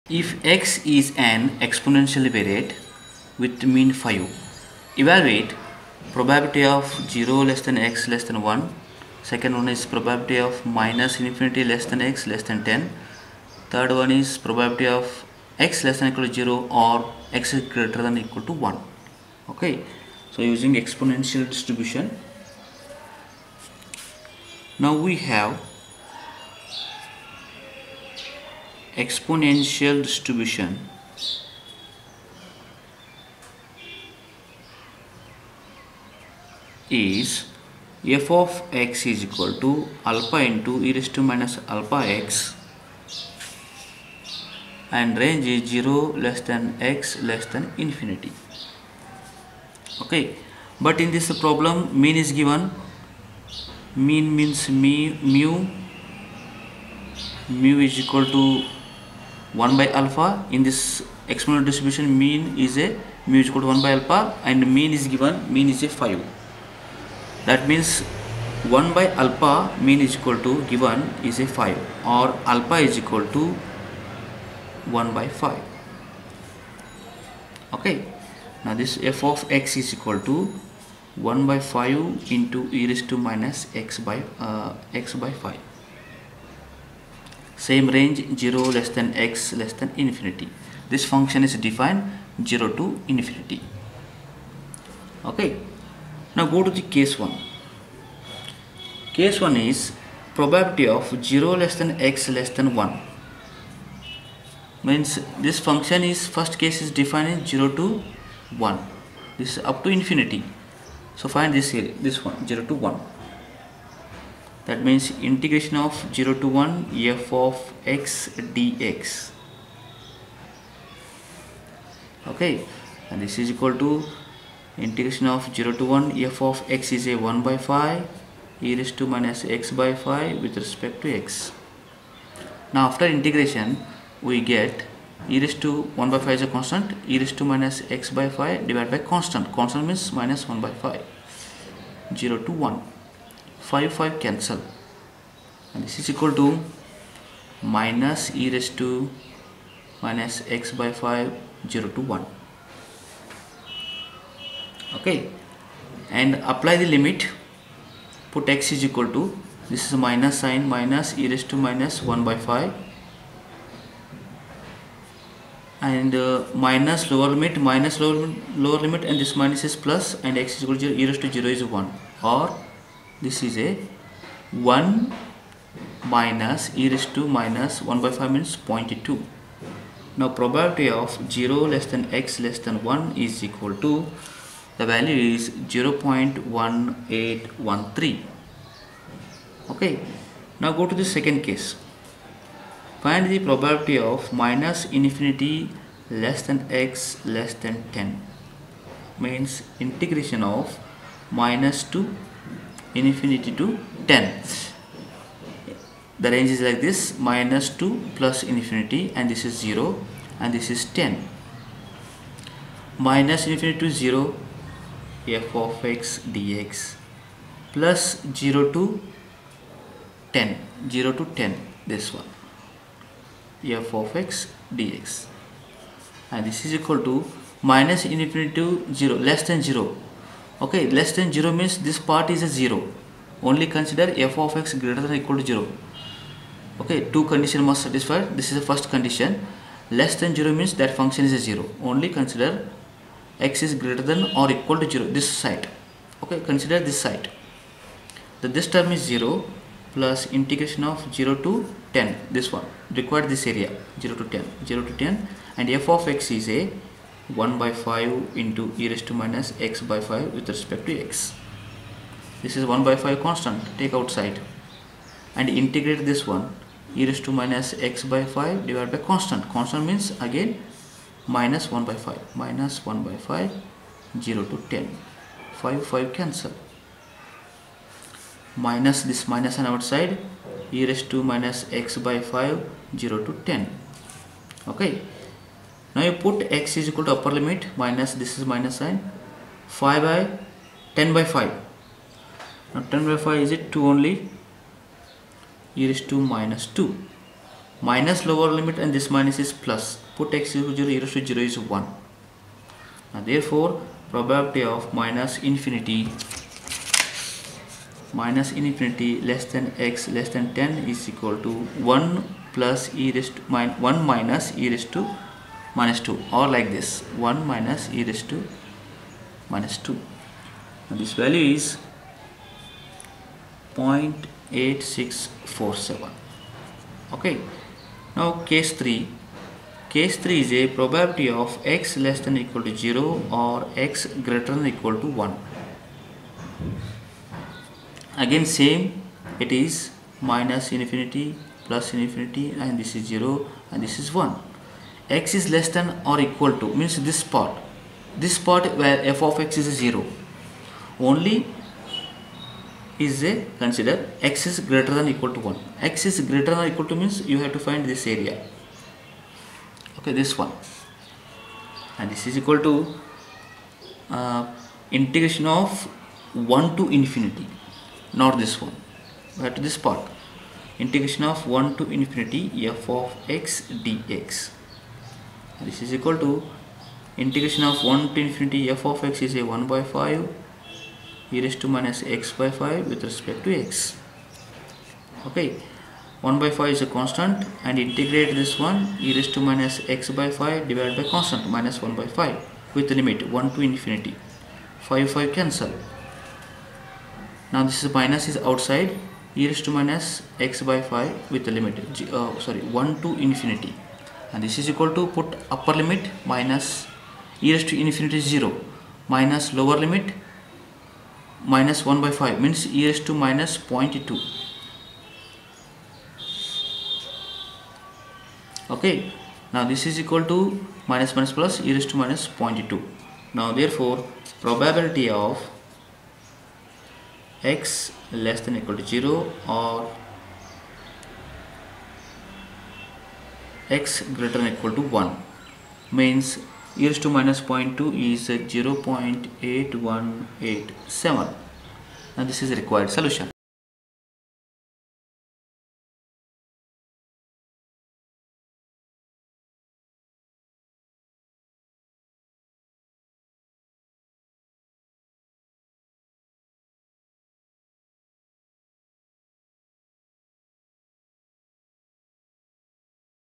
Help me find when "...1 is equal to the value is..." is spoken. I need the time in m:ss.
3:02.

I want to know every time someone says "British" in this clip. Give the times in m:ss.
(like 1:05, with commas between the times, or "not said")
not said.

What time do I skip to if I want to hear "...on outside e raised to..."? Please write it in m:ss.
4:39.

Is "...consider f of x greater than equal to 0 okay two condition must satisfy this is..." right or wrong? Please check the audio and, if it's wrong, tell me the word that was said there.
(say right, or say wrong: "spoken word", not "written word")
right.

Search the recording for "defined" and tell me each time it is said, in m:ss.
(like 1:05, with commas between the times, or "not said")
1:31, 1:47.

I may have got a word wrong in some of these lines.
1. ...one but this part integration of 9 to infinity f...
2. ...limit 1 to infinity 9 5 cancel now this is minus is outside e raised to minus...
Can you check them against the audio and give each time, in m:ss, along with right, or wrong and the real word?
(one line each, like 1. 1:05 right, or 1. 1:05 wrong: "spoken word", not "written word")
1. 6:08 wrong: "1", not "9"
2. 6:33 wrong: "5", not "9".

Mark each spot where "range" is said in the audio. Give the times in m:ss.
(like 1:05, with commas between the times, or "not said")
0:45, 1:27, 3:26.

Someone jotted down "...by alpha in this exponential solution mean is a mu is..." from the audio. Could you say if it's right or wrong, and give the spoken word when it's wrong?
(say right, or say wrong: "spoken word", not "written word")
wrong: "distribution", not "solution".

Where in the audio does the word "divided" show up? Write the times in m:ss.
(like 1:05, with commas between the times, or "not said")
2:18, 4:28, 6:30.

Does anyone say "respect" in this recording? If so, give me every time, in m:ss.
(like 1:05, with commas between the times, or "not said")
2:10, 4:20, 6:23.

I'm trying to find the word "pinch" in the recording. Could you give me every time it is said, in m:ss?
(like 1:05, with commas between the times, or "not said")
not said.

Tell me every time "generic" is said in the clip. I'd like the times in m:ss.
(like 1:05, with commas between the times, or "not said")
not said.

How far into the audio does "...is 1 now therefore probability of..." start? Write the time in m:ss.
5:01.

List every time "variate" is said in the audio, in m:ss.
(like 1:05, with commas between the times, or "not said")
0:02.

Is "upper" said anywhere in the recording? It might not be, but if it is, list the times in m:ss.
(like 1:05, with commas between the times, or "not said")
4:47, 6:45.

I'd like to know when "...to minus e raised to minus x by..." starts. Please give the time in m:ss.
2:26.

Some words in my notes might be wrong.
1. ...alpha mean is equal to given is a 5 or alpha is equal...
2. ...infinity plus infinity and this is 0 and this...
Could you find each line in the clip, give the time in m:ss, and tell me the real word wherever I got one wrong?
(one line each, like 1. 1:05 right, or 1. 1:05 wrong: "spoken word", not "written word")
1. 1:09 right
2. 5:40 right.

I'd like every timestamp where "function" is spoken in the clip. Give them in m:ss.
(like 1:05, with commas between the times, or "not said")
1:31, 1:45, 4:00.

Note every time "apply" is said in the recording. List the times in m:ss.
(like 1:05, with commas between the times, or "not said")
2:36.